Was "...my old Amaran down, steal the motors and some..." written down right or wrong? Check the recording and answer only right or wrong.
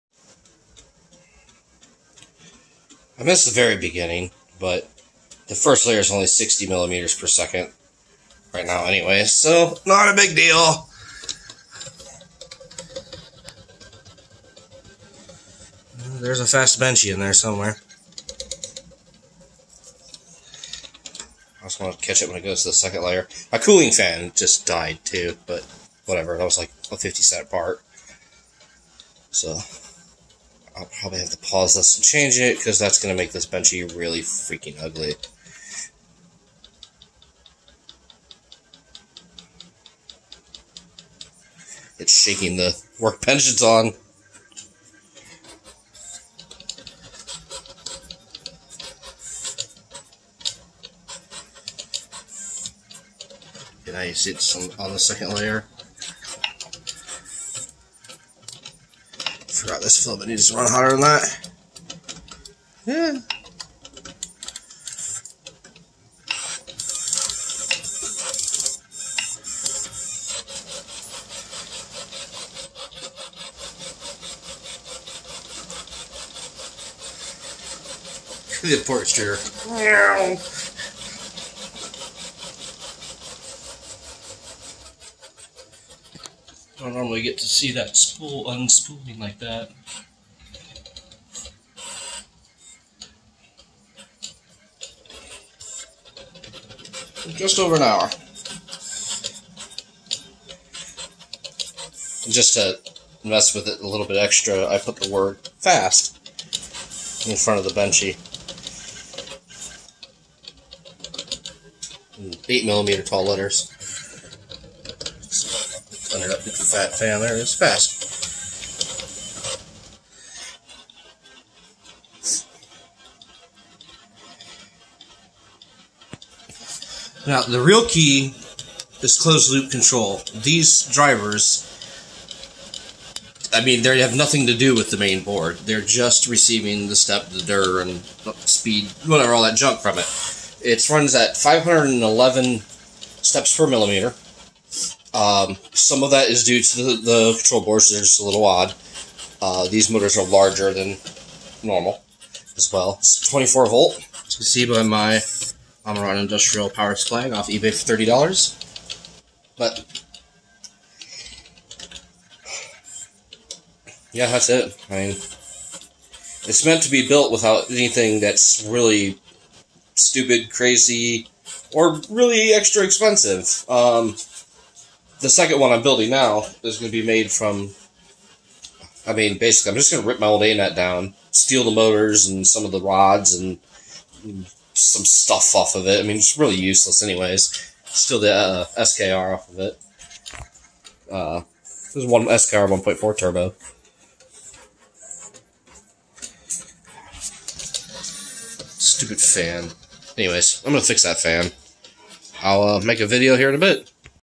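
wrong.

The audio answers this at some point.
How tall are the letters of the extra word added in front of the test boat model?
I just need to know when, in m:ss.
1:52.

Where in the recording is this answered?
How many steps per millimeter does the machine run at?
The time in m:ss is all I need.
2:21.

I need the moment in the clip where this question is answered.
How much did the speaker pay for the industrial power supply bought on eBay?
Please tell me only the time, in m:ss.
2:37.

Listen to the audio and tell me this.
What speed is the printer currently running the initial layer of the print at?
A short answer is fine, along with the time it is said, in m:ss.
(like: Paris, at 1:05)
60 millimeters per second, at 0:06.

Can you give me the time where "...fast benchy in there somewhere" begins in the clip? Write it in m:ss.
0:16.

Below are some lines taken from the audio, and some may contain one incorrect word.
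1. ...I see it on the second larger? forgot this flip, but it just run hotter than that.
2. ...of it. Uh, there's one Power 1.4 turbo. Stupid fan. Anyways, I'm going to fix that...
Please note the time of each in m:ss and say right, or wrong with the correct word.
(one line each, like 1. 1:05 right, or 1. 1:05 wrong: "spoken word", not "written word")
1. 0:53 wrong: "layer", not "larger"
2. 3:09 wrong: "SKR", not "Power".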